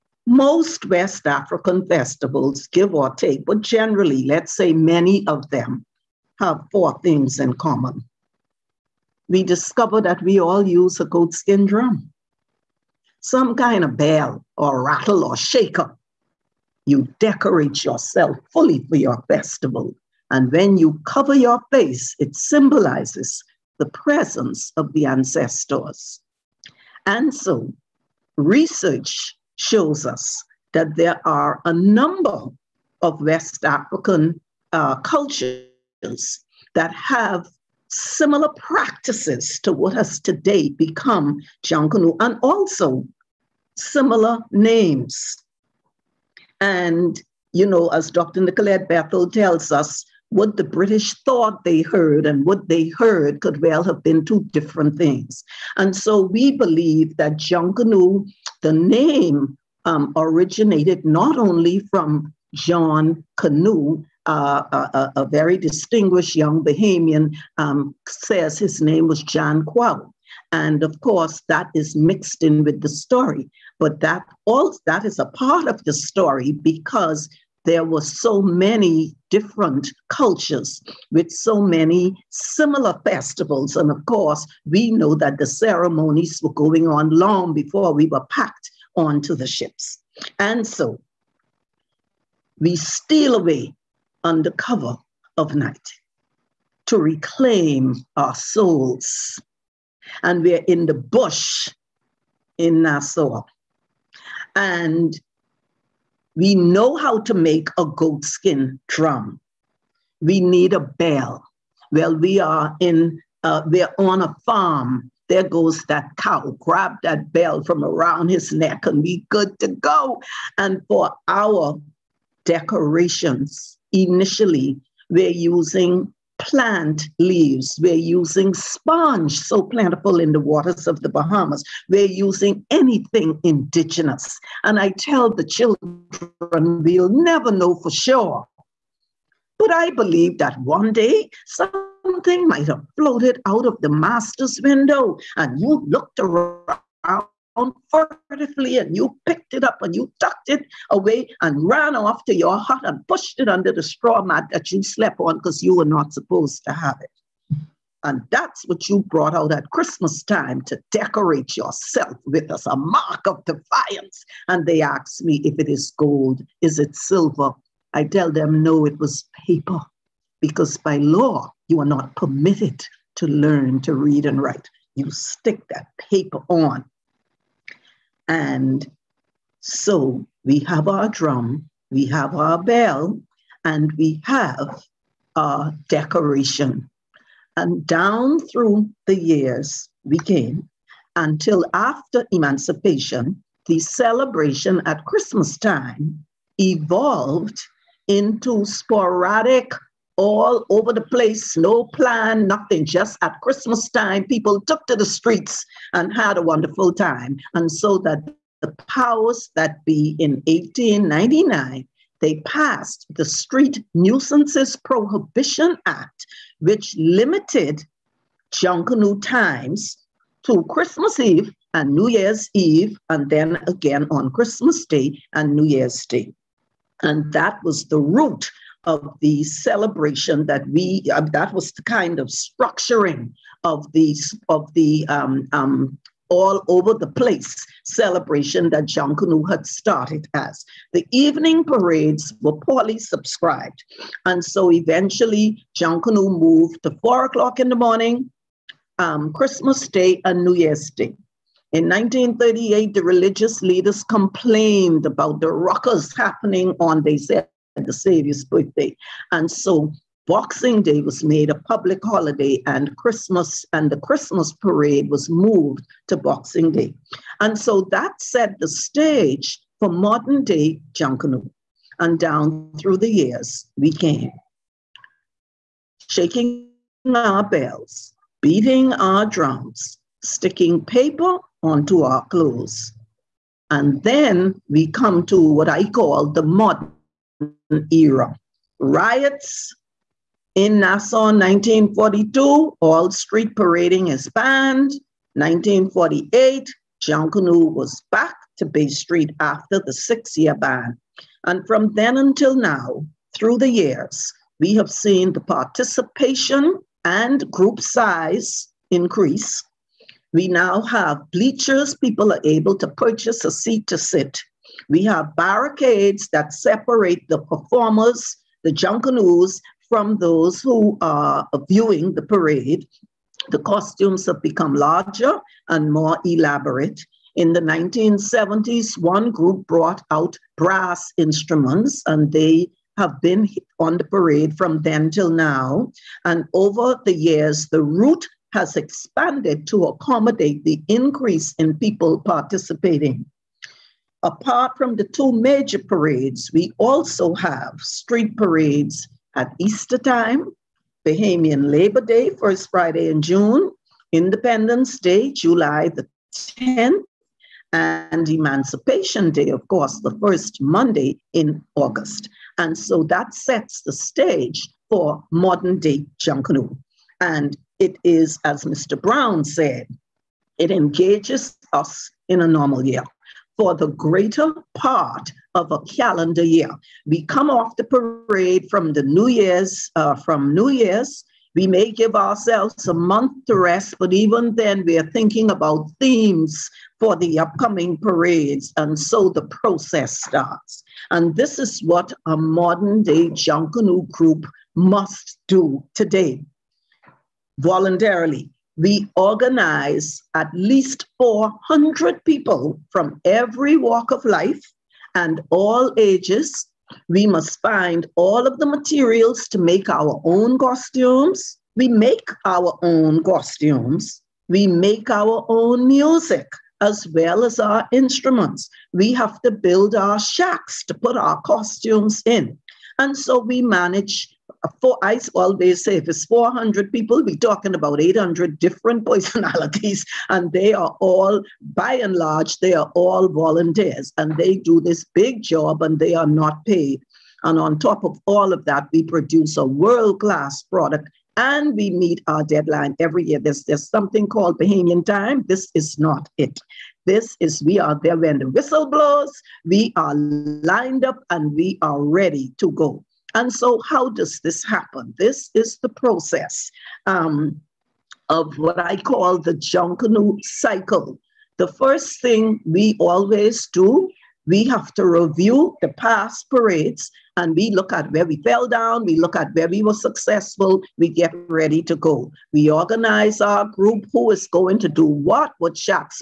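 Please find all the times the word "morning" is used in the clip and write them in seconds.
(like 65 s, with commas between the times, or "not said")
247 s.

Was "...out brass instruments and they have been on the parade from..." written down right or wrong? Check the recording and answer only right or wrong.
right.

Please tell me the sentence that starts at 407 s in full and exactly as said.
We must find all of the materials to make our own costumes.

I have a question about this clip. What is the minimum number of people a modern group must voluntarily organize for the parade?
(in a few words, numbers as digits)
400.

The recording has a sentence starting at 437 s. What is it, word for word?
And on top of all of that, we produce a world-class product, and we meet our deadline every year.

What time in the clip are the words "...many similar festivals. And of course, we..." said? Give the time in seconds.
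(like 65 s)
81 s.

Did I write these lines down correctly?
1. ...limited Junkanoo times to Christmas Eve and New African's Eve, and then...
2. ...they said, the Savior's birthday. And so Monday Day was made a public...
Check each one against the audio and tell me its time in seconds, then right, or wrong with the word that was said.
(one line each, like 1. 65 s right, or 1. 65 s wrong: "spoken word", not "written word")
1. 216 s wrong: "Year", not "African"
2. 257 s wrong: "Boxing", not "Monday".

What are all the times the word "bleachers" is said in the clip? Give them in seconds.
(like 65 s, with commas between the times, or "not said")
311 s.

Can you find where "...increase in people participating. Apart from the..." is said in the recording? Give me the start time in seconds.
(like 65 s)
340 s.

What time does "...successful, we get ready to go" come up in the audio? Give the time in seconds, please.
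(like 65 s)
469 s.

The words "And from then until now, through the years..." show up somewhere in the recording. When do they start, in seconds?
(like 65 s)
301 s.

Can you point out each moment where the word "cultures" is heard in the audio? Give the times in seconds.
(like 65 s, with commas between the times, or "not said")
34 s, 80 s.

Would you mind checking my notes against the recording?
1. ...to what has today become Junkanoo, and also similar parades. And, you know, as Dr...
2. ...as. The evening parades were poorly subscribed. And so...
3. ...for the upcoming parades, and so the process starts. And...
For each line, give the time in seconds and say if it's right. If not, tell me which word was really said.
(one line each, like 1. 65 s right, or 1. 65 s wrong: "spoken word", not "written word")
1. 39 s wrong: "names", not "parades"
2. 240 s right
3. 386 s right.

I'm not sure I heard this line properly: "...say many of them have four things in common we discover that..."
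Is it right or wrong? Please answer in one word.
right.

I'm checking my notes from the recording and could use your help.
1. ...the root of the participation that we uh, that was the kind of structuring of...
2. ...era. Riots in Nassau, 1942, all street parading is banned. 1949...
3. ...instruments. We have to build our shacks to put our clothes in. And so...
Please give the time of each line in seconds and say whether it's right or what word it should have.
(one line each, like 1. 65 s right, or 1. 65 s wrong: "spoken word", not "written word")
1. 227 s wrong: "celebration", not "participation"
2. 287 s wrong: "1948", not "1949"
3. 417 s wrong: "costumes", not "clothes".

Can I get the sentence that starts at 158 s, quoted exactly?
And that's what you brought out at Christmas time to decorate yourself with as a mark of defiance.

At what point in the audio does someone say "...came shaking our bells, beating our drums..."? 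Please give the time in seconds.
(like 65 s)
273 s.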